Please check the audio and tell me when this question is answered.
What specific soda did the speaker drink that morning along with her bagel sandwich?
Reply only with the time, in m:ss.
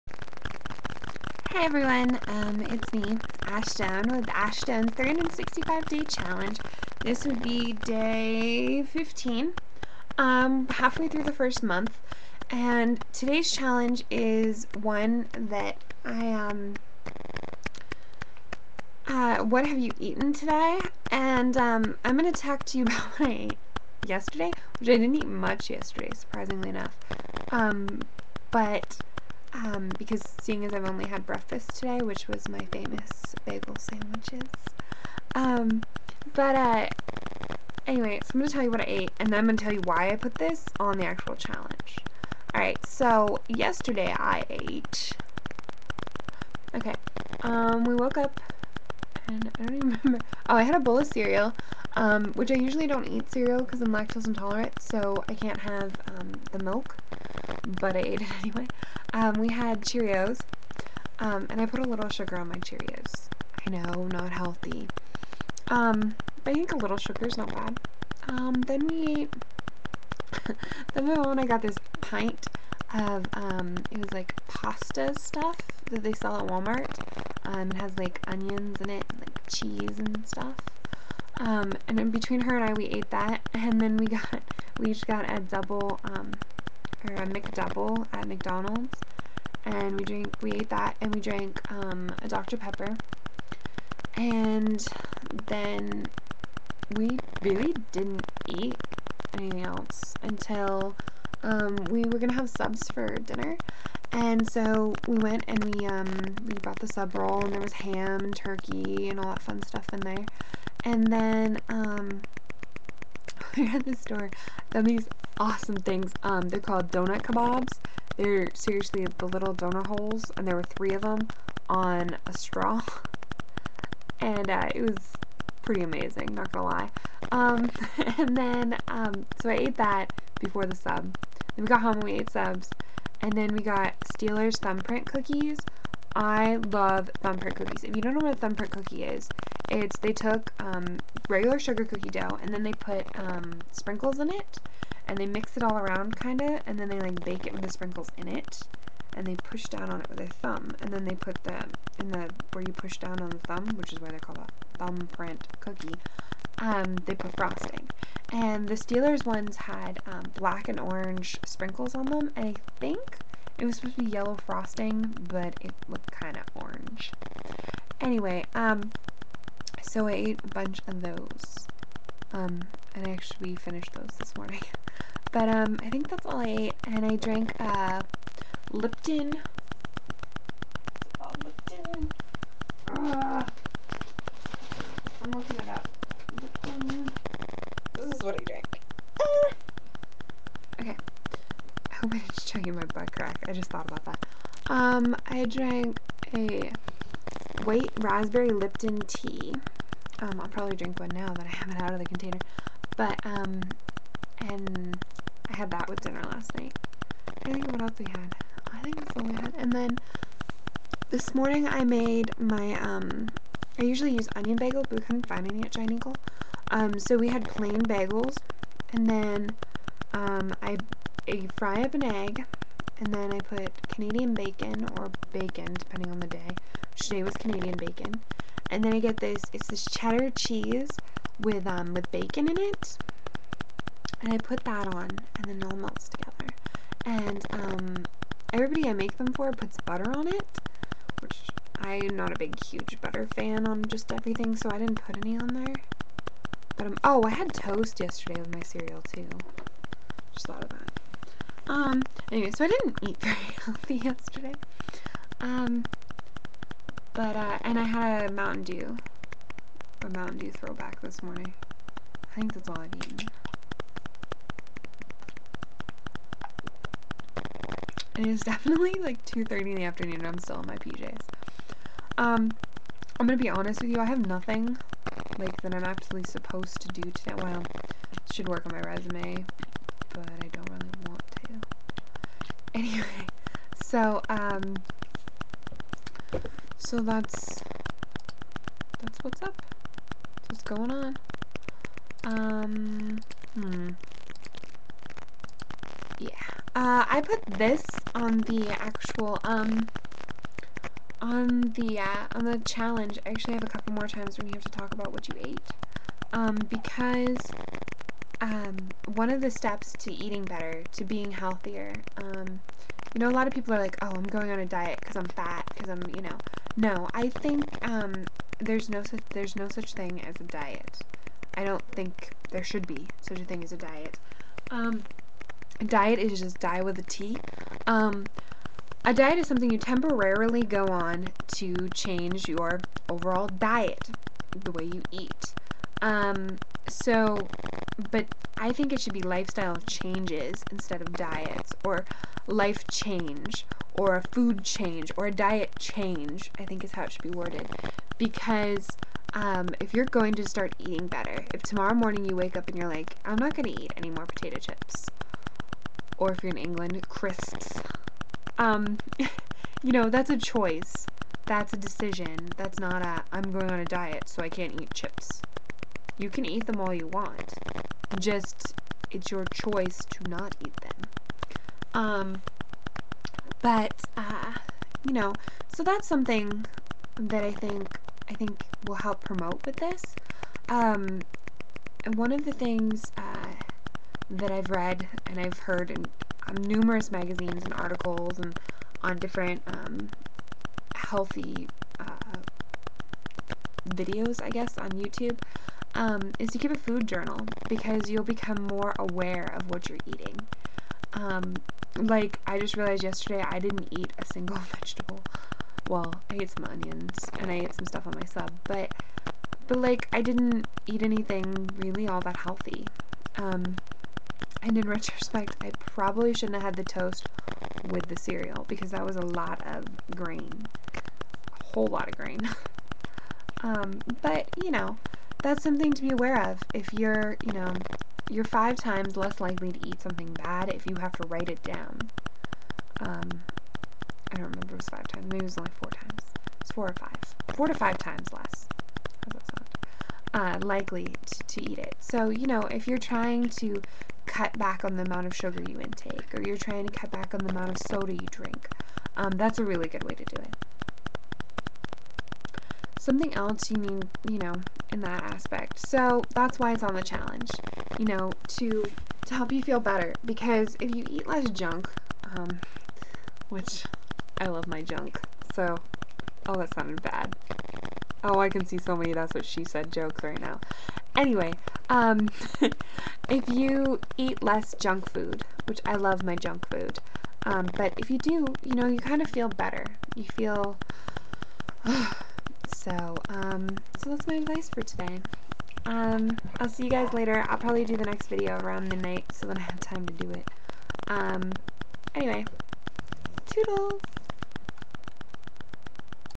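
4:20.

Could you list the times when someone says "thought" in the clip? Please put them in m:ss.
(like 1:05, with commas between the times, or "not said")
3:13, 4:10.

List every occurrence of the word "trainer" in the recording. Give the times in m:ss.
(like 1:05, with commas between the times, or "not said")
not said.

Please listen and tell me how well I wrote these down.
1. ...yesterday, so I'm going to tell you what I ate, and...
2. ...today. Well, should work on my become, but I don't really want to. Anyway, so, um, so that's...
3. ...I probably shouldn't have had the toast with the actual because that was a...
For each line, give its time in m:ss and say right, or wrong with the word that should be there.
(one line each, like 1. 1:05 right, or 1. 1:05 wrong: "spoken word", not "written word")
1. 0:37 wrong: "anyway", not "yesterday"
2. 4:37 wrong: "resume", not "become"
3. 6:55 wrong: "cereal", not "actual".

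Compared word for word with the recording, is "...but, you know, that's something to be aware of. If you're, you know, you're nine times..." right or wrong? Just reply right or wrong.
wrong.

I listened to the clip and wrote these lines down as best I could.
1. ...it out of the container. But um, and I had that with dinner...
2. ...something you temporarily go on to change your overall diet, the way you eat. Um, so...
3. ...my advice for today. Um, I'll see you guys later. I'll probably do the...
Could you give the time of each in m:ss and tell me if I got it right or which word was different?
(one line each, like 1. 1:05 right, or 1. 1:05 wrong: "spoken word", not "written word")
1. 3:21 right
2. 5:29 right
3. 8:04 right.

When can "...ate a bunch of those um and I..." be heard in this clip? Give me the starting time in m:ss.
2:50.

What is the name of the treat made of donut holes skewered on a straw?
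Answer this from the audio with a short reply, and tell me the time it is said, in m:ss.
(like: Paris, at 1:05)
donut kebabs, at 1:56.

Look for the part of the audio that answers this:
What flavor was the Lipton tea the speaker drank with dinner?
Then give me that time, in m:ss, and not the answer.
3:17.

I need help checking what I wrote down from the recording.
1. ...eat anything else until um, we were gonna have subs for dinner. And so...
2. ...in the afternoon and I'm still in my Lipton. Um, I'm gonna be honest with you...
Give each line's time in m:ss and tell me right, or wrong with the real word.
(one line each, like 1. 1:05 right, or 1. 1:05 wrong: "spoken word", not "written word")
1. 1:38 right
2. 4:29 wrong: "PJs", not "Lipton".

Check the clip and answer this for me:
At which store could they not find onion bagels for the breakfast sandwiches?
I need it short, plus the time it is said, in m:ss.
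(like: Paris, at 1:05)
Giant Eagle, at 3:35.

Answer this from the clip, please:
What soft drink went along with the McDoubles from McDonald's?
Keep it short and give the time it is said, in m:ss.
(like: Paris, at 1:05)
Dr. Pepper, at 1:32.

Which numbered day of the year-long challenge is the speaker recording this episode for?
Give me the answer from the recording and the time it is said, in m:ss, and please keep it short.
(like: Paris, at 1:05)
15, at 0:08.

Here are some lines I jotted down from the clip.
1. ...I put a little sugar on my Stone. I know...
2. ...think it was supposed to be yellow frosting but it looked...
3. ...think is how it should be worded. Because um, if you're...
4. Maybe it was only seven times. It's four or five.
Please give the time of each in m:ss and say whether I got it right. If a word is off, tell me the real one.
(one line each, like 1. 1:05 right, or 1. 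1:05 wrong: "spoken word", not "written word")
1. 1:01 wrong: "Cheerios", not "Stone"
2. 2:42 right
3. 5:46 right
4. 7:15 wrong: "four", not "seven".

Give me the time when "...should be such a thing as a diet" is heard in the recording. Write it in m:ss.
5:22.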